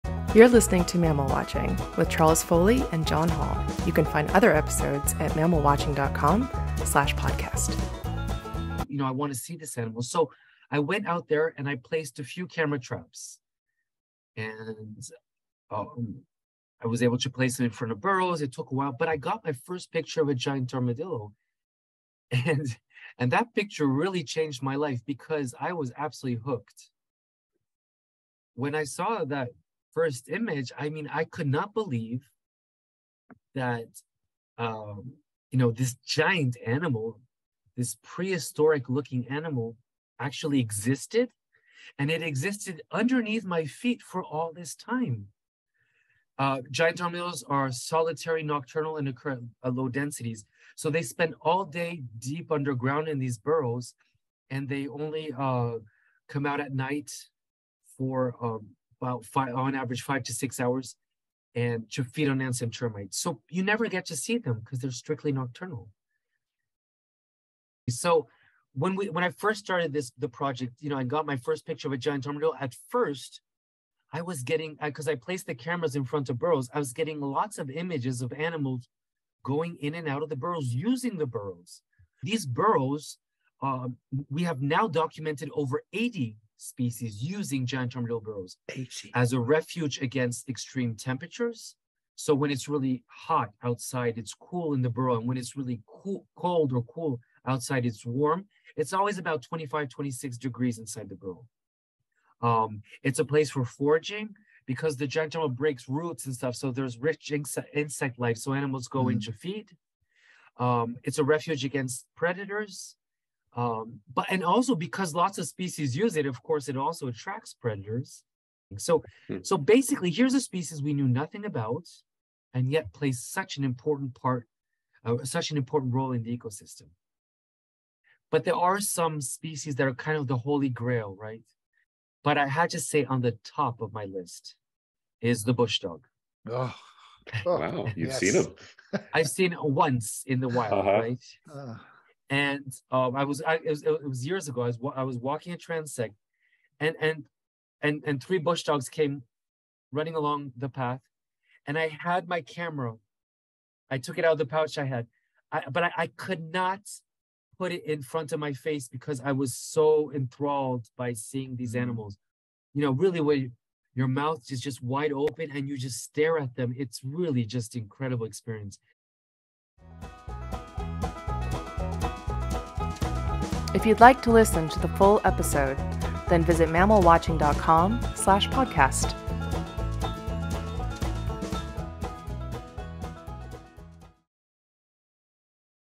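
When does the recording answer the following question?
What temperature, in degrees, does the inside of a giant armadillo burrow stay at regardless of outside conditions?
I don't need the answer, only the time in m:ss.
1:39.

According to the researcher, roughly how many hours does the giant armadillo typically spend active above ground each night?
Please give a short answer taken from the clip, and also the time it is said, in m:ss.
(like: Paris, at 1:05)
5 to 6 hours, at 1:00.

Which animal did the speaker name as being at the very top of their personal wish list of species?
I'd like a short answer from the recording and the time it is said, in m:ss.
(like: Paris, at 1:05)
bush dog, at 2:15.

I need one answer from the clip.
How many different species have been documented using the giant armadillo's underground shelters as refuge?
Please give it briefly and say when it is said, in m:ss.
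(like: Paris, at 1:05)
over 80, at 1:25.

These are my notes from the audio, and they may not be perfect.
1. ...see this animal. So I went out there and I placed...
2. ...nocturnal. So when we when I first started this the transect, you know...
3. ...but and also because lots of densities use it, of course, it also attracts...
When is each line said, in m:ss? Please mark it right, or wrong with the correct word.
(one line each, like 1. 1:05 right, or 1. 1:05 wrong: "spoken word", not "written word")
1. 0:09 right
2. 1:05 wrong: "project", not "transect"
3. 1:54 wrong: "species", not "densities".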